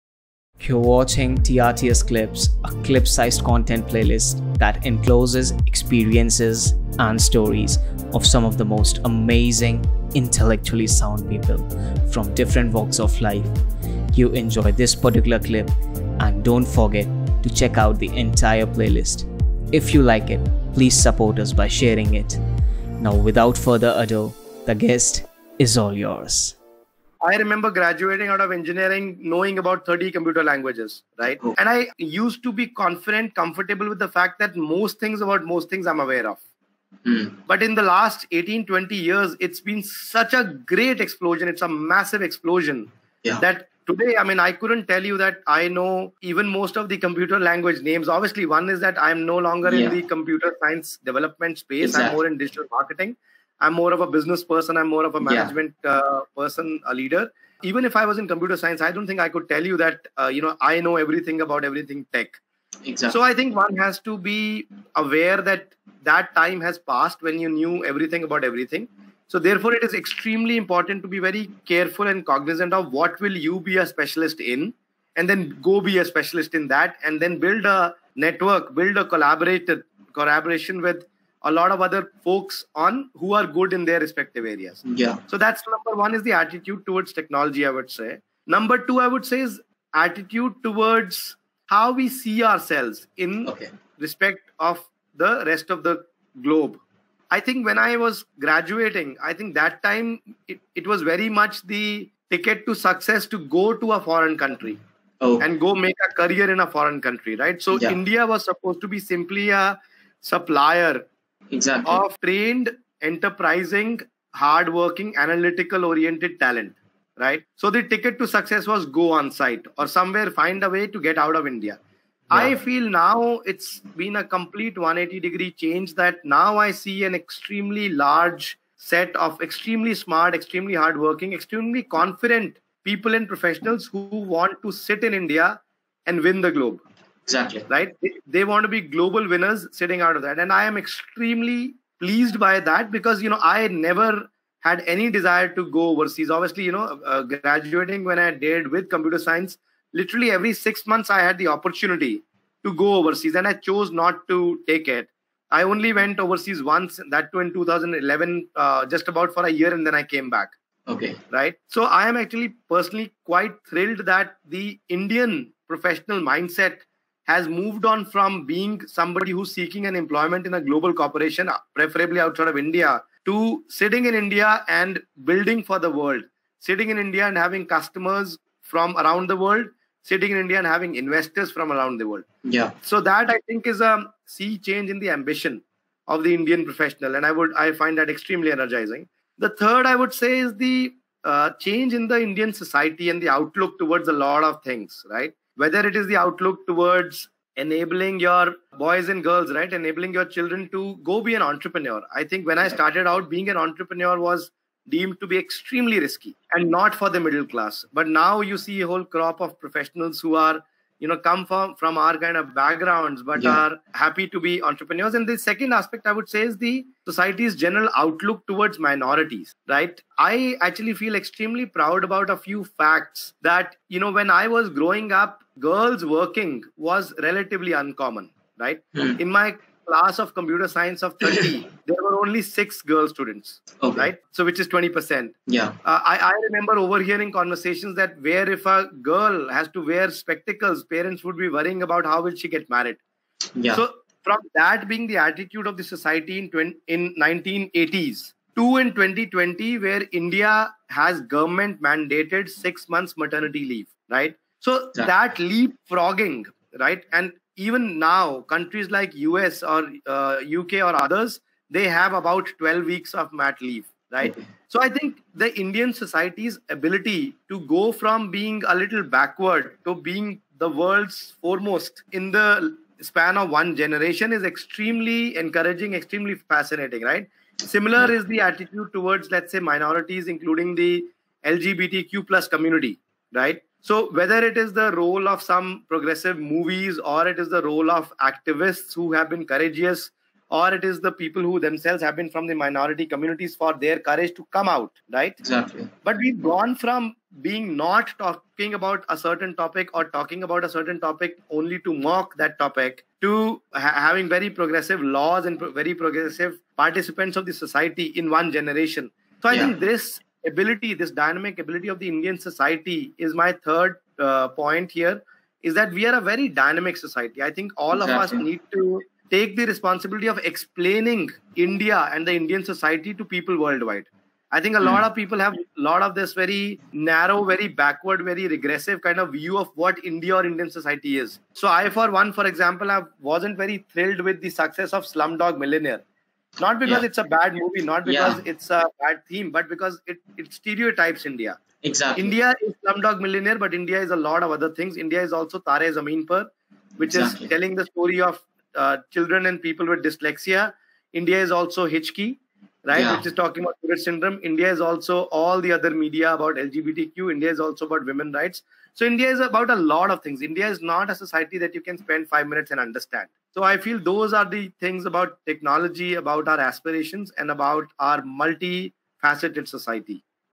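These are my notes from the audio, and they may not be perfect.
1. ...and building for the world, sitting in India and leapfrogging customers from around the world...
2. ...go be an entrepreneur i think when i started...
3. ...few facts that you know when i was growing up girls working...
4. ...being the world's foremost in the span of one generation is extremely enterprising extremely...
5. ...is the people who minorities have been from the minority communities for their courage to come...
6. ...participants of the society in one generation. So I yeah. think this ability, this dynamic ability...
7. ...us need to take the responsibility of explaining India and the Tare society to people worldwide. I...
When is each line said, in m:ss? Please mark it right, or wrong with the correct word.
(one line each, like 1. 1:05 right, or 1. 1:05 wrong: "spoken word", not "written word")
1. 2:54 wrong: "having", not "leapfrogging"
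2. 3:21 right
3. 3:42 right
4. 4:29 wrong: "encouraging", not "enterprising"
5. 4:50 wrong: "themselves", not "minorities"
6. 5:06 right
7. 5:18 wrong: "Indian", not "Tare".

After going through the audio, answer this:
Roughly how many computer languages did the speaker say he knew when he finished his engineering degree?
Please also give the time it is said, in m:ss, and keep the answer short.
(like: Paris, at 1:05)
30, at 0:29.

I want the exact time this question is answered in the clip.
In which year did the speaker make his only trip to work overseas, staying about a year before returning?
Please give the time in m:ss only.
2:37.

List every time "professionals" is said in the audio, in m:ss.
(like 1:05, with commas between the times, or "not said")
2:13, 2:45, 3:06, 3:29.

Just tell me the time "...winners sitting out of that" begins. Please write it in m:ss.
2:19.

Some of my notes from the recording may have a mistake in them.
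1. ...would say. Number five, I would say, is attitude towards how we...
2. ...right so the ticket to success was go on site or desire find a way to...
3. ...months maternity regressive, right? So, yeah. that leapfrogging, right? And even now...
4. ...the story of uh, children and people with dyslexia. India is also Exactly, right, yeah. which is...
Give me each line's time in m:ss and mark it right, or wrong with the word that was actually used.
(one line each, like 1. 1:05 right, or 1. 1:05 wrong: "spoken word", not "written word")
1. 1:27 wrong: "two", not "five"
2. 1:57 wrong: "somewhere", not "desire"
3. 4:12 wrong: "leave", not "regressive"
4. 5:47 wrong: "Hichki", not "Exactly".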